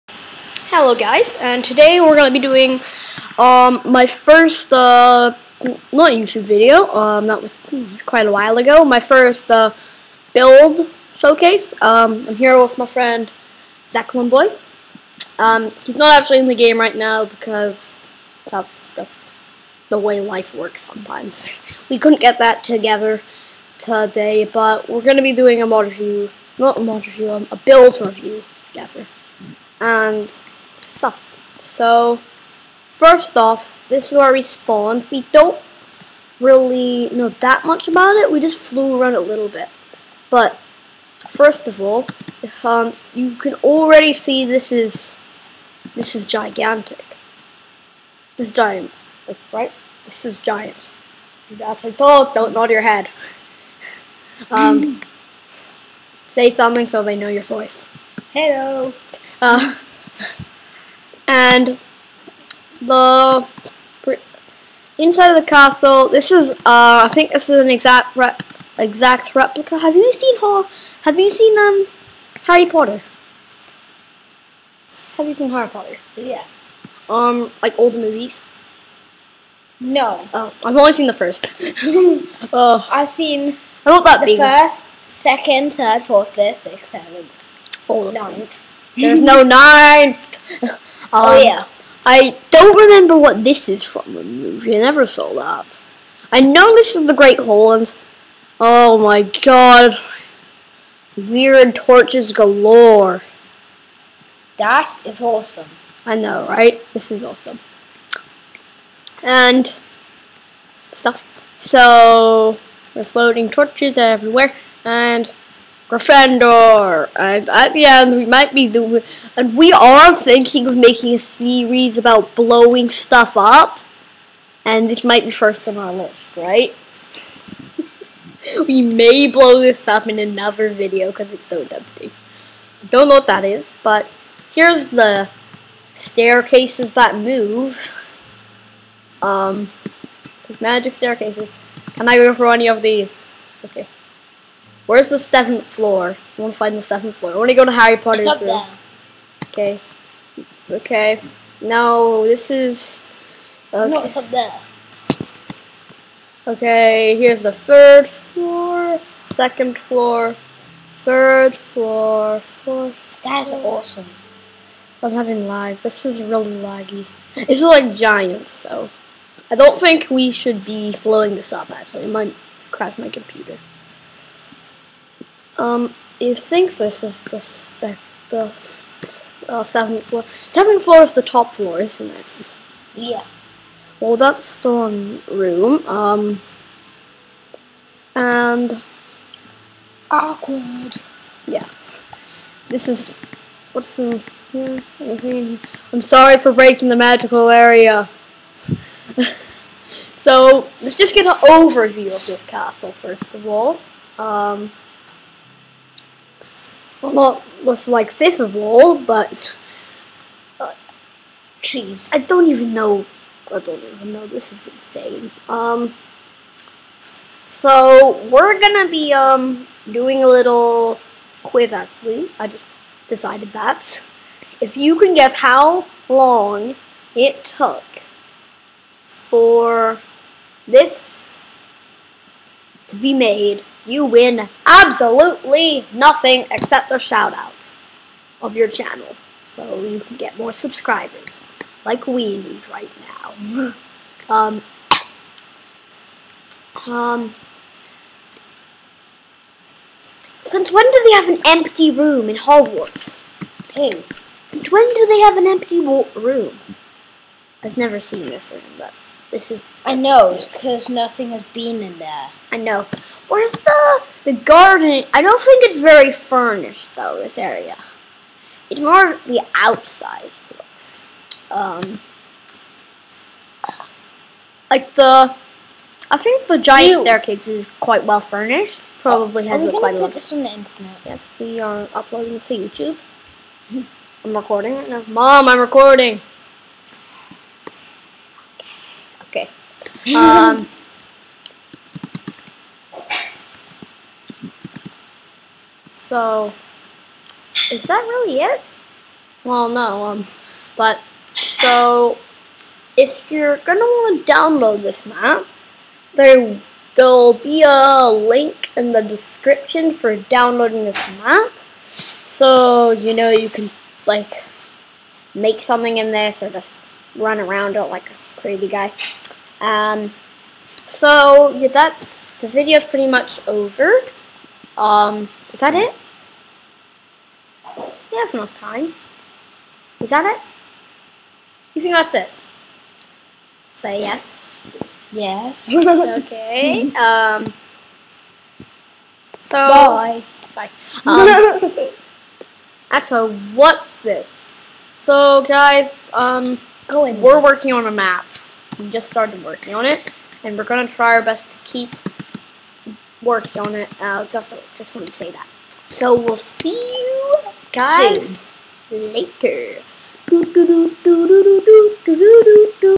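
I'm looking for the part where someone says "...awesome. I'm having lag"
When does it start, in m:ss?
2:43.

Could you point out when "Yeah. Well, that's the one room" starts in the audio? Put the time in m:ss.
3:02.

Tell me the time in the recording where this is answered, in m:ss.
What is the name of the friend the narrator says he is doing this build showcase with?
0:13.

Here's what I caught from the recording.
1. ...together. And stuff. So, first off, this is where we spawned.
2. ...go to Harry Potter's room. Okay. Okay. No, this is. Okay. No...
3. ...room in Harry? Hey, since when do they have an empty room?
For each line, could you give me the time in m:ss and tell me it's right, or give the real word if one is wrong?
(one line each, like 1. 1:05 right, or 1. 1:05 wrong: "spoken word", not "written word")
1. 0:28 right
2. 2:27 right
3. 4:11 wrong: "Hogwarts", not "Harry".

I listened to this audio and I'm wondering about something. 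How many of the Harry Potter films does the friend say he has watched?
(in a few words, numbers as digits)
The first.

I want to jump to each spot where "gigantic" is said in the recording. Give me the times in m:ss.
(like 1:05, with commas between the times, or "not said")
0:46.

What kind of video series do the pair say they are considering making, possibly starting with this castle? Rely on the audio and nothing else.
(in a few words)
Blowing stuff up.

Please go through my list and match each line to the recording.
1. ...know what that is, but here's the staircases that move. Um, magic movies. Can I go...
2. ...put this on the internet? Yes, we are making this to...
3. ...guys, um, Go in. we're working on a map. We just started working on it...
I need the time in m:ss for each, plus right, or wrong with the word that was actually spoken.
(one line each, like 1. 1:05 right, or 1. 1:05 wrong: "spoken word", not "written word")
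1. 2:13 wrong: "staircases", not "movies"
2. 4:40 wrong: "uploading", not "making"
3. 5:45 right.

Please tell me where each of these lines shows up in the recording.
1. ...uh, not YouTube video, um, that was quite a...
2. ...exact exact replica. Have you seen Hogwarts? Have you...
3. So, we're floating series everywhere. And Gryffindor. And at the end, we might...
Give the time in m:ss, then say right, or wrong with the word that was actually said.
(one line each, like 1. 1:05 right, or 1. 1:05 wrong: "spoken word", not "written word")
1. 0:04 right
2. 1:07 wrong: "Hall", not "Hogwarts"
3. 1:51 wrong: "torches", not "series".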